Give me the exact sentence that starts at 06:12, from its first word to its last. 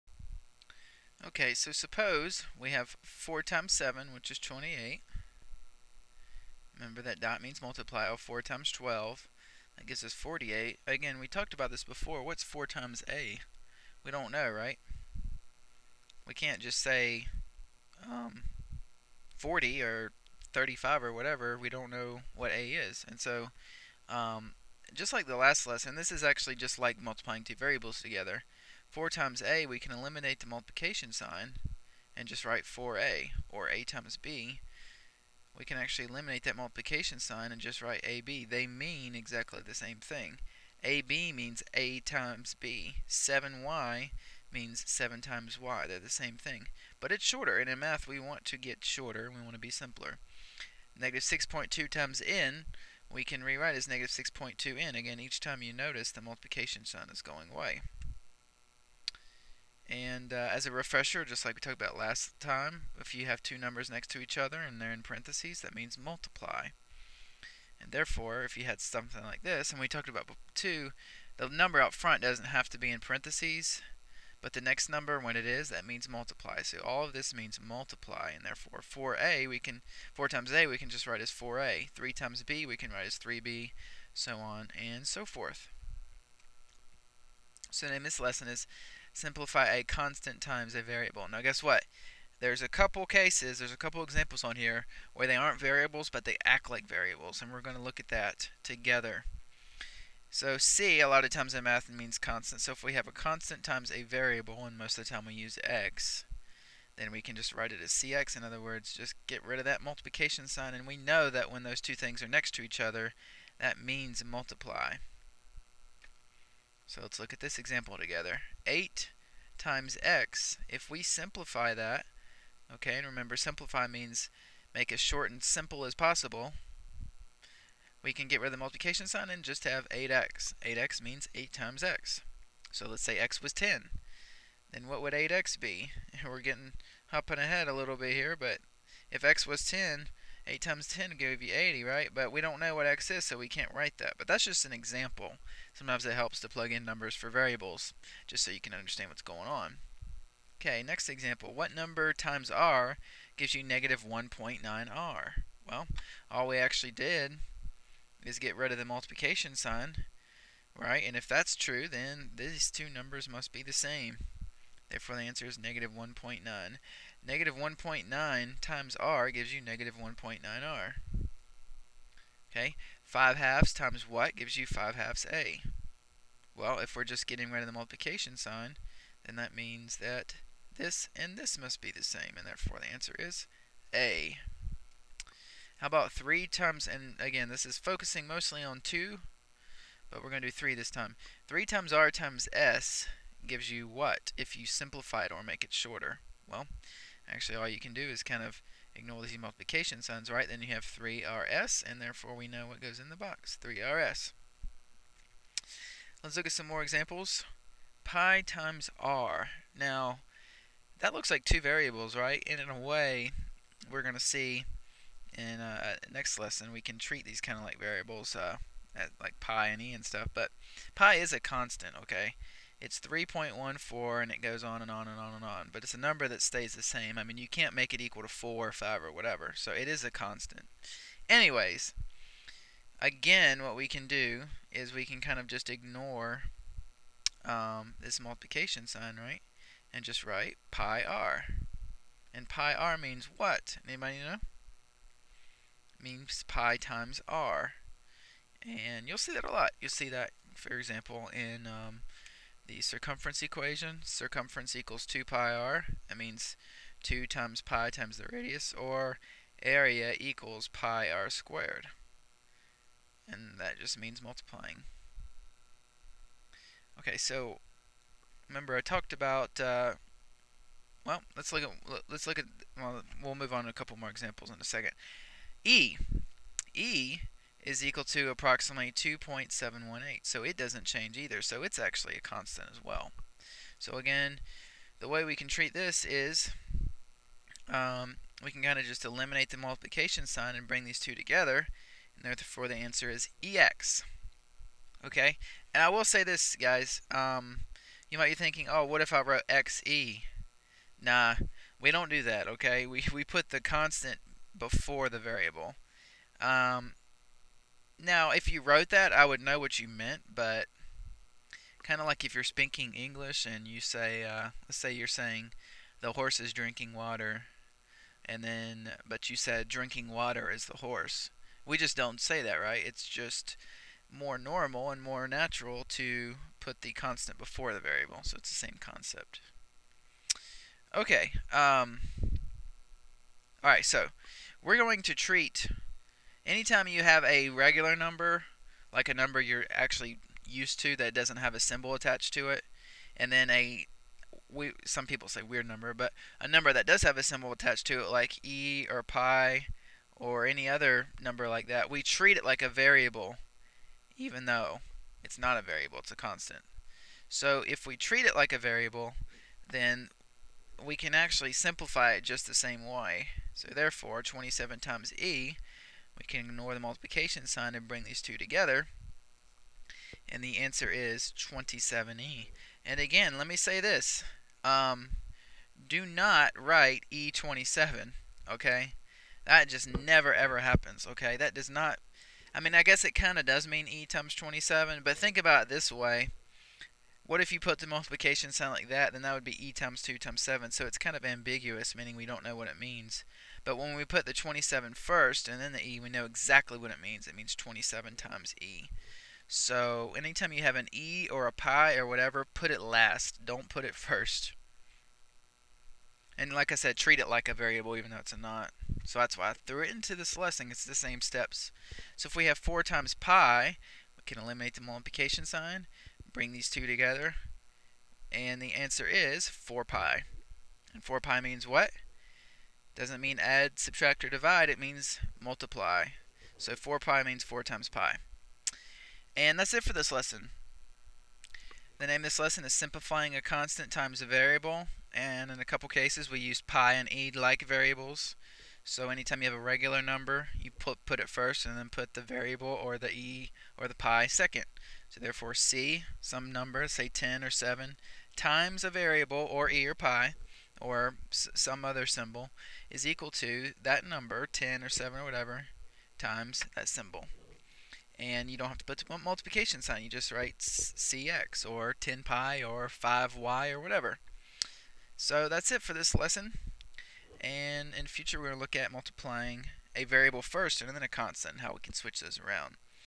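And again, let me say this.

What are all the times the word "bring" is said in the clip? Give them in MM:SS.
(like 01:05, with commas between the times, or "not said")
04:50, 06:07, 06:56.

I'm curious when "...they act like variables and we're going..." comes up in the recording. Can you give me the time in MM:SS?
01:36.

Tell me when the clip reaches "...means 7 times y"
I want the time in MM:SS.
00:44.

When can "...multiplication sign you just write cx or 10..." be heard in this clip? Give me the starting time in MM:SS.
07:39.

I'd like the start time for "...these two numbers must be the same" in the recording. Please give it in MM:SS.
02:42.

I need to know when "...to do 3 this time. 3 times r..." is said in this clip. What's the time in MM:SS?
03:10.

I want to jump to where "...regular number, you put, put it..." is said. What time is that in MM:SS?
07:19.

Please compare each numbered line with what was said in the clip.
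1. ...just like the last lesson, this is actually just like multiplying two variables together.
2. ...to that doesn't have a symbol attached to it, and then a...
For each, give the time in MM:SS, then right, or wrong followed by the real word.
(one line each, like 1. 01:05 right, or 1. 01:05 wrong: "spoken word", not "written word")
1. 00:24 right
2. 05:40 right.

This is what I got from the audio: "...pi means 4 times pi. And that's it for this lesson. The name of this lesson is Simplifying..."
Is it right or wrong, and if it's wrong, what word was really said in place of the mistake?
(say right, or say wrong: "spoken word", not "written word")
right.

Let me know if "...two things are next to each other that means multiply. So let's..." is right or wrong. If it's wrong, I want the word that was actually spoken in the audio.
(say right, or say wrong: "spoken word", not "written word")
right.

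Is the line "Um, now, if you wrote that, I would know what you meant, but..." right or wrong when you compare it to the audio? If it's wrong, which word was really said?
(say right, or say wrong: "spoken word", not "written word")
right.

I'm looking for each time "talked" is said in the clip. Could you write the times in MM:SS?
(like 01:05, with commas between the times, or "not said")
00:11, 01:01, 01:09, 04:28.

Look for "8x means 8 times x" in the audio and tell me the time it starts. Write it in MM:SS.
02:10.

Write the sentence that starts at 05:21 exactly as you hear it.
We just don't say that, right?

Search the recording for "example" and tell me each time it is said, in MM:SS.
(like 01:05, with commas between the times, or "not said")
01:34, 01:57, 02:24, 02:31, 03:26, 04:10, 04:34.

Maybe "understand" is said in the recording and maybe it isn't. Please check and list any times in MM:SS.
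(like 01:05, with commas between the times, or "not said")
02:28.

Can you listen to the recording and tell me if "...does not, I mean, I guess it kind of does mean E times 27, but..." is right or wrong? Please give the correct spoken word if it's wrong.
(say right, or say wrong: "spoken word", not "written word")
right.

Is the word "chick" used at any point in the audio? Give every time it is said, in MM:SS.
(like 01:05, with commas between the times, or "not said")
not said.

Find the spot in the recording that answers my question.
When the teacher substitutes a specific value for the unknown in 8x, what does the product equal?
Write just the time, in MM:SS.
02:21.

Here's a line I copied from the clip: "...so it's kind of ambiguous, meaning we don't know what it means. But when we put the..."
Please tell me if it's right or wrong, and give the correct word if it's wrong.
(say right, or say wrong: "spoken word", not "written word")
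right.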